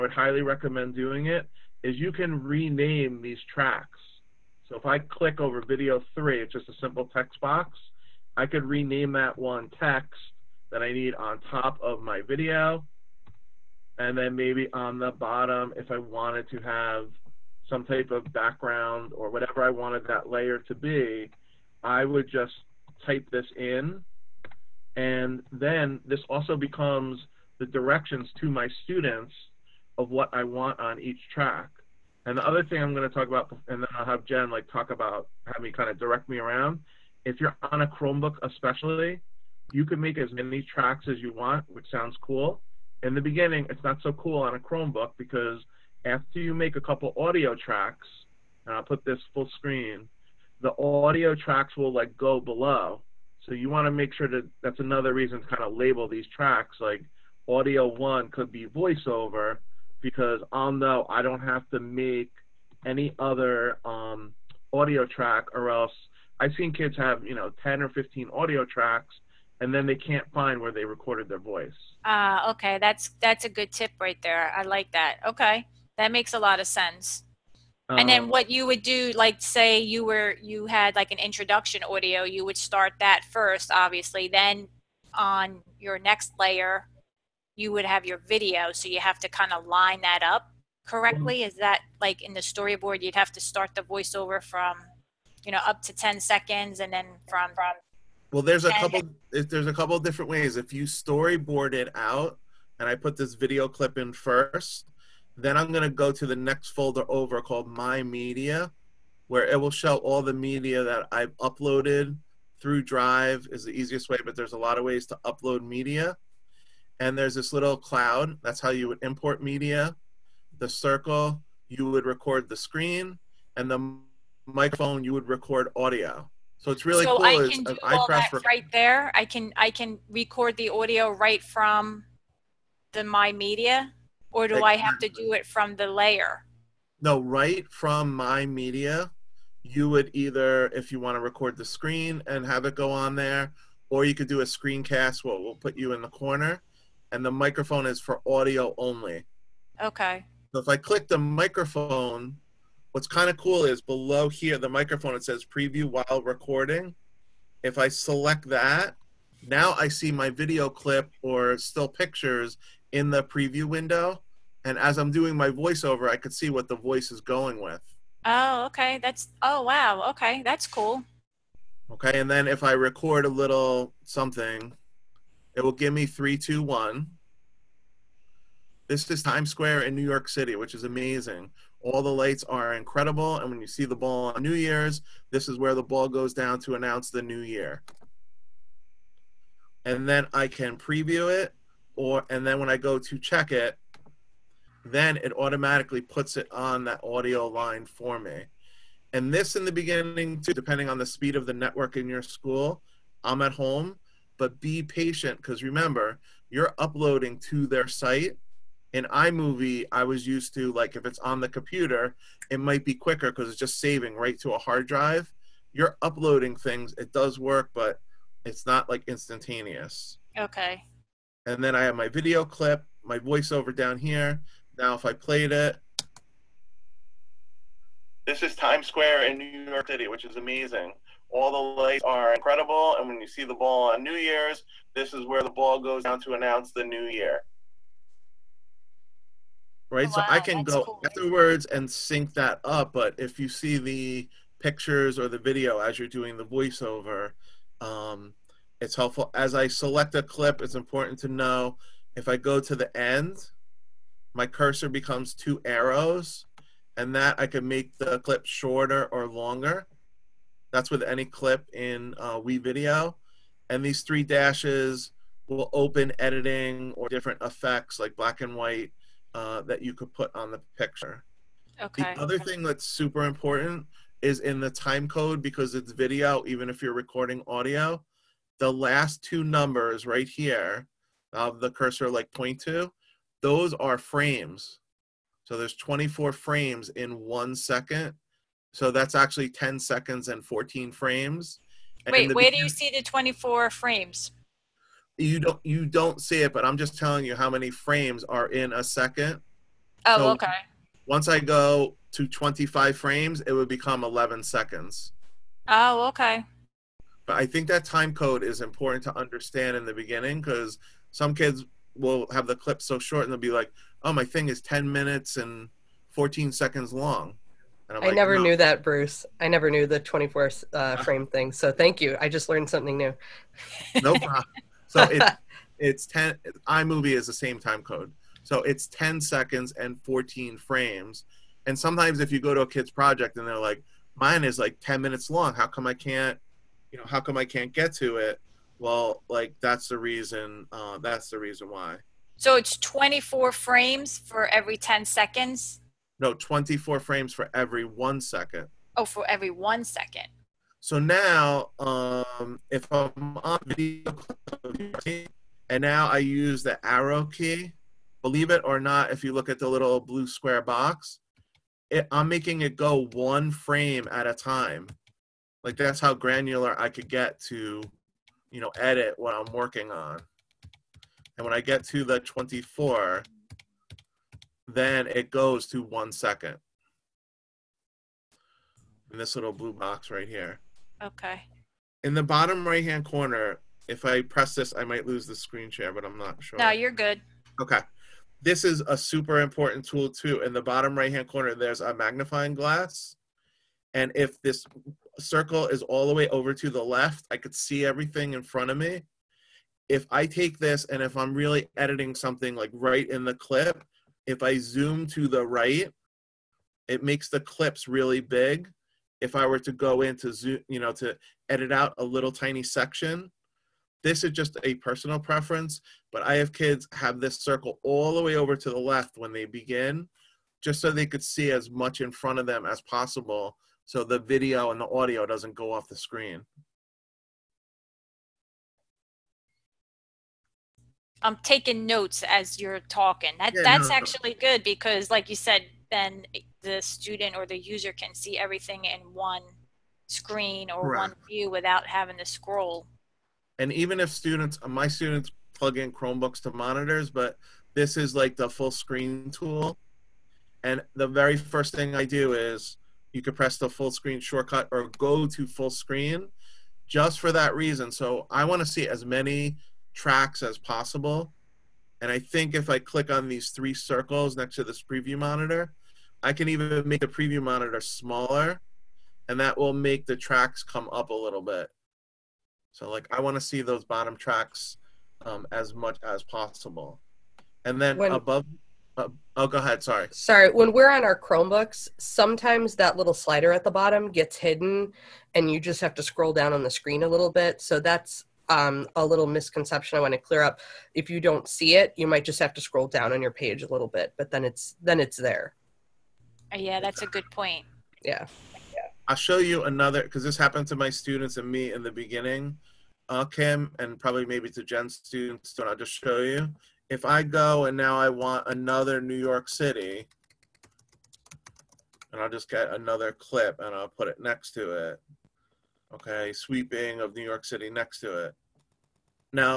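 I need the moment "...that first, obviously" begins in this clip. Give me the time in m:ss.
1:22.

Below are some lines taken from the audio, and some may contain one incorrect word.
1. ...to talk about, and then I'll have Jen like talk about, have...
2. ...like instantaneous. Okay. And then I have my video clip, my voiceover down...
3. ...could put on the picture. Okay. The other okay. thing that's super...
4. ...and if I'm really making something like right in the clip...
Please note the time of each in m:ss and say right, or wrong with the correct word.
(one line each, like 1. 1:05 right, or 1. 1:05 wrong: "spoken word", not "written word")
1. 0:33 right
2. 3:38 right
3. 4:29 right
4. 6:40 wrong: "editing", not "making".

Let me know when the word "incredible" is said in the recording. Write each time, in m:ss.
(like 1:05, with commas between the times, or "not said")
3:02, 3:52.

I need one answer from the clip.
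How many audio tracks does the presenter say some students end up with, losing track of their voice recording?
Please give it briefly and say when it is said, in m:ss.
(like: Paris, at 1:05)
10 or 15, at 1:07.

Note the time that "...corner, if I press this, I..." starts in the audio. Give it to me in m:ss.
6:23.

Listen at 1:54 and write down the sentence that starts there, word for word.
But there's a lot of ways to upload media, and there's this little cloud.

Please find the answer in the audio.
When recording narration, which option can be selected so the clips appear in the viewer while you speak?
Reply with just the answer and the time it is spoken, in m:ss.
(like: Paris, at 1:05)
Preview while recording, at 2:35.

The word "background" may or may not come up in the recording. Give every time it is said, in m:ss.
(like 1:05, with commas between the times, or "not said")
0:18.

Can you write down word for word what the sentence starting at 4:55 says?
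you don't you don't see it, but I'm just telling you how many frames are in a second.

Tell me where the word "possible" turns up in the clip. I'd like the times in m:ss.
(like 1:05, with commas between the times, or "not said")
7:02, 7:40, 7:56.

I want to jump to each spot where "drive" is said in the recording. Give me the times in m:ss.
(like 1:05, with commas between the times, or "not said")
1:52, 3:34.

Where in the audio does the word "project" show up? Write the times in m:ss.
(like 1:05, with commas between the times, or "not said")
5:32.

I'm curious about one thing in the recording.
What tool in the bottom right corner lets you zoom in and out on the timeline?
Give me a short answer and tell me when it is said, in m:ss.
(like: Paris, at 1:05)
Magnifying glass, at 6:31.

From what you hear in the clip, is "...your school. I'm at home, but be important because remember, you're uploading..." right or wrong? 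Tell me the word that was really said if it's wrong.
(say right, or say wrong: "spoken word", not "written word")
wrong: "patient", not "important".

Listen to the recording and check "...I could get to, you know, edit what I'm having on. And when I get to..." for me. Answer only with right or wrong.
wrong.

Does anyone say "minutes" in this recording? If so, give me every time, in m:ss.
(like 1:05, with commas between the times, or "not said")
5:14, 5:35.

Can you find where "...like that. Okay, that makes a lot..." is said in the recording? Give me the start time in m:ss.
1:14.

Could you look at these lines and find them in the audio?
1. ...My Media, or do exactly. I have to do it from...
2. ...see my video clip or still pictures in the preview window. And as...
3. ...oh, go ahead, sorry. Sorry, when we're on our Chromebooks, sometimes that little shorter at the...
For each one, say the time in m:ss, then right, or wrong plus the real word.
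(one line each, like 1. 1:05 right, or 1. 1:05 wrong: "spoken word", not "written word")
1. 2:13 right
2. 2:39 right
3. 7:59 wrong: "slider", not "shorter".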